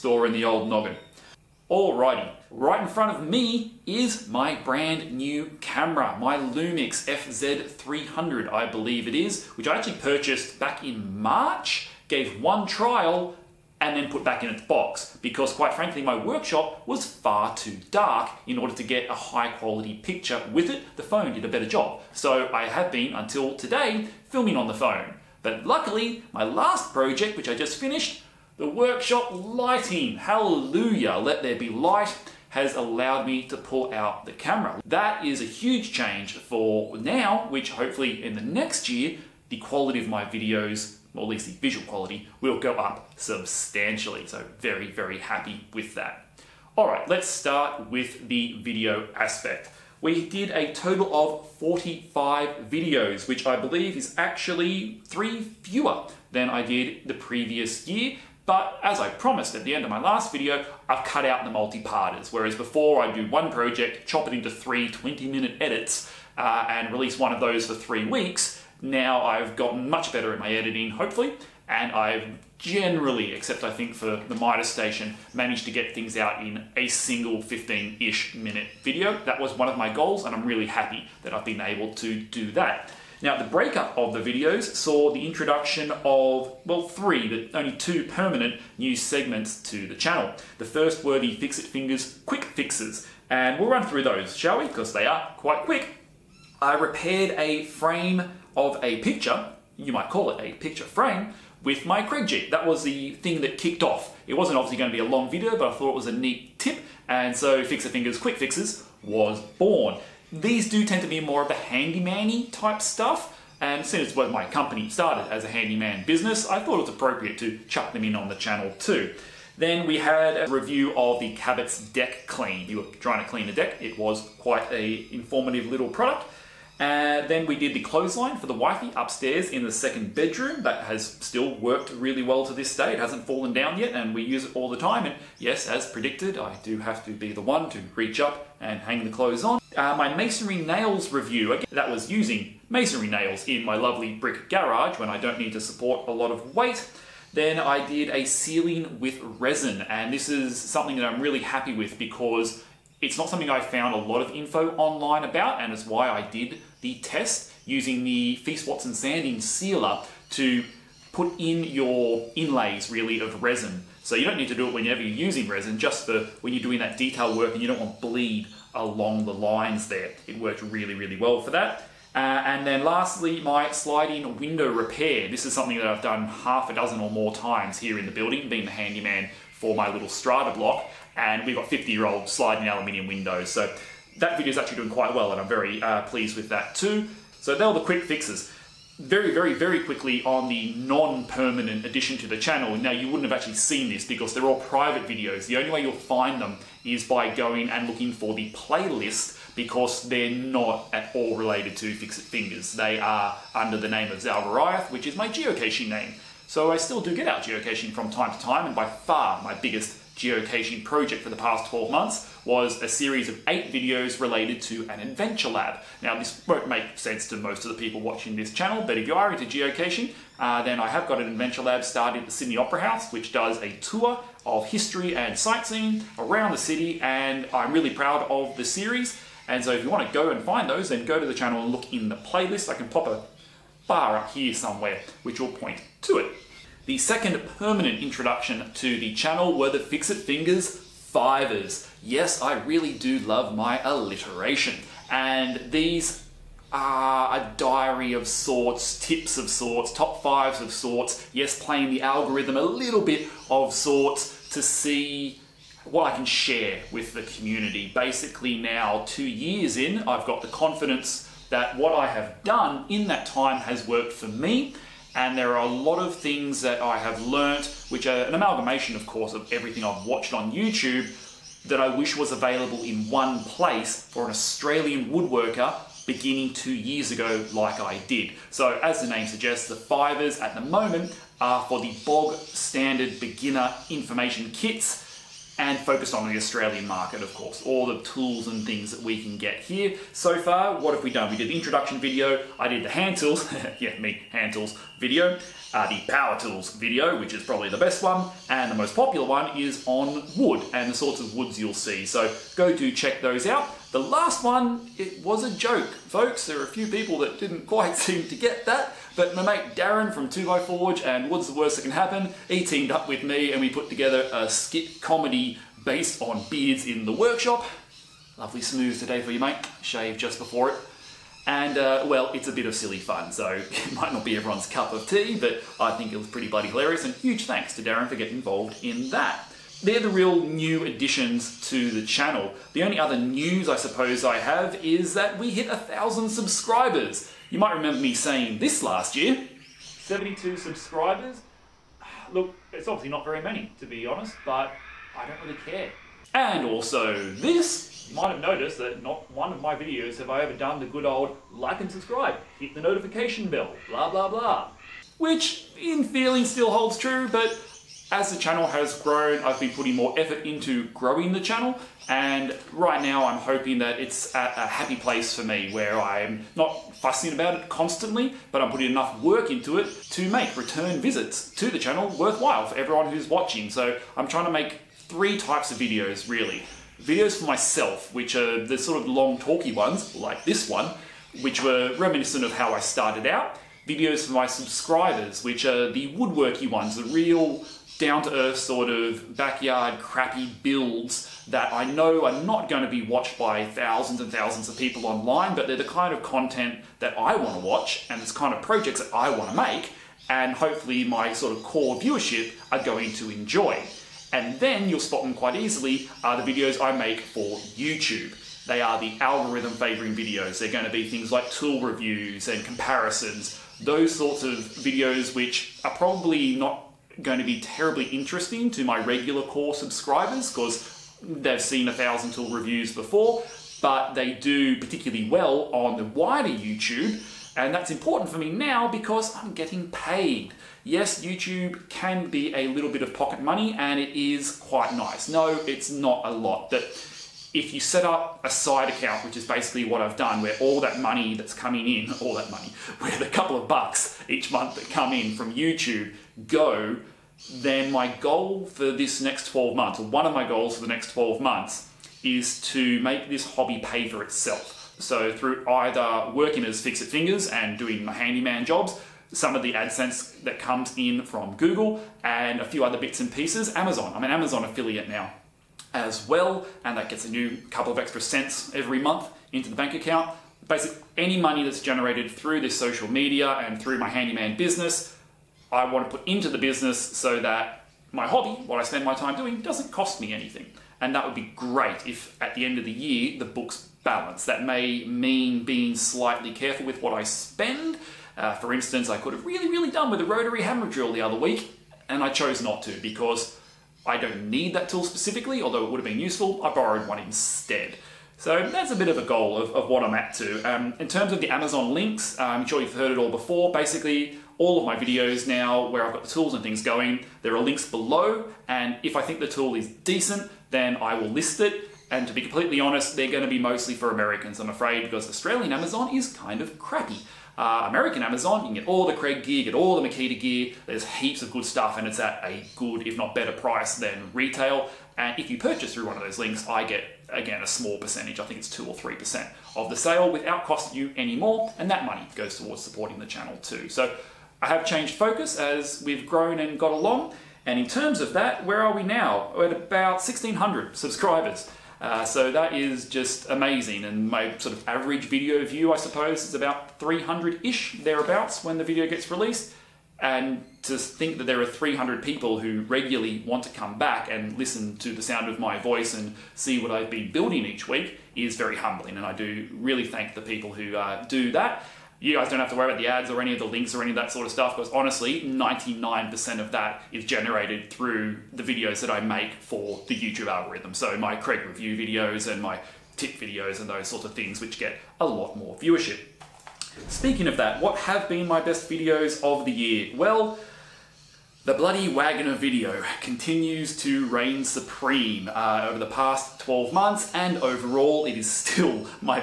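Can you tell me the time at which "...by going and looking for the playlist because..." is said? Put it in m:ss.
3:17.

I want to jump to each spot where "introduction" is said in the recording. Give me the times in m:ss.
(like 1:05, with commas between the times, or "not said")
1:25, 3:58, 4:51.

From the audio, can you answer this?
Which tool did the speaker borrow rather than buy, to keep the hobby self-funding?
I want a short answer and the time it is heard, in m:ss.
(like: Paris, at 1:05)
rotary hammer drill, at 8:10.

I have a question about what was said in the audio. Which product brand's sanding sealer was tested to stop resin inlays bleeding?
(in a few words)
Feast Watson.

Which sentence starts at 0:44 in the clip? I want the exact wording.
So very, very happy with that.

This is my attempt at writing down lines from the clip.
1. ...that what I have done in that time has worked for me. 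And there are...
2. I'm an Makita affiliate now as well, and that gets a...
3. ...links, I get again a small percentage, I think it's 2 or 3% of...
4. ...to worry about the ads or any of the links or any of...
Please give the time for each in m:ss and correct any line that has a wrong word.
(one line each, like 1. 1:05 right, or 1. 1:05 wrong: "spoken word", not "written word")
1. 4:21 right
2. 7:44 wrong: "Amazon", not "Makita"
3. 8:46 right
4. 9:22 right.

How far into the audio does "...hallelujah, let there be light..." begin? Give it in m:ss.
0:30.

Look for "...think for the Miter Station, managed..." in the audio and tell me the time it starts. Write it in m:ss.
1:13.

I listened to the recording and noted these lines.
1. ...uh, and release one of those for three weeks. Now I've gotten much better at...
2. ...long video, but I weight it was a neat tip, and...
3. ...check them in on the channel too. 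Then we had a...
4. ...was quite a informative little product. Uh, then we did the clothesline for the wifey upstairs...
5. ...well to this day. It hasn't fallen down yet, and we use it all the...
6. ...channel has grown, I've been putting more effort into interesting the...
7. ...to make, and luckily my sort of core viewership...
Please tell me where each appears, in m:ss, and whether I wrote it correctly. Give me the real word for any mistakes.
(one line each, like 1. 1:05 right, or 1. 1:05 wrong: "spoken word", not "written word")
1. 1:06 right
2. 1:45 wrong: "thought", not "weight"
3. 1:57 wrong: "chuck", not "check"
4. 2:03 right
5. 2:12 right
6. 5:58 wrong: "growing", not "interesting"
7. 6:39 wrong: "hopefully", not "luckily".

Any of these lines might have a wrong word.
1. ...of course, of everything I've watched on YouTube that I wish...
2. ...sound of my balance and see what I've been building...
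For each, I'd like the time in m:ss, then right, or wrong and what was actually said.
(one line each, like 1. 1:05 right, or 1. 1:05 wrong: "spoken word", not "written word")
1. 4:28 right
2. 9:15 wrong: "voice", not "balance".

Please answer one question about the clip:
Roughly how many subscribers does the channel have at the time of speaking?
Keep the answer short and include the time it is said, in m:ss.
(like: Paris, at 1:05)
1,600, at 9:00.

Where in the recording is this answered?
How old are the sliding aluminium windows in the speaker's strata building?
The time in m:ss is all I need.
3:01.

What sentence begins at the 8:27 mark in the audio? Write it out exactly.
There are links below, and if I think the tool is decent, then I will list it.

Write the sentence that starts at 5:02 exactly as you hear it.
So go do check those out.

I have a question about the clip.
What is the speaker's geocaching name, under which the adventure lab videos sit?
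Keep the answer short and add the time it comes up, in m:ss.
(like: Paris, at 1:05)
Zalvariath, at 3:24.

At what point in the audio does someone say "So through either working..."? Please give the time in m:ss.
7:34.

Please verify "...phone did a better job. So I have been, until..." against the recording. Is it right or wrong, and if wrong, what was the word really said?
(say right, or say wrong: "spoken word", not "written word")
right.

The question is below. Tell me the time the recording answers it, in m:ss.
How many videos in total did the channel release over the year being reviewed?
0:51.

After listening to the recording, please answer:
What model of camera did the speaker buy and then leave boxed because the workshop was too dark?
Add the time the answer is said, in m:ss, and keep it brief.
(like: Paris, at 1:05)
Lumix FZ300, at 0:06.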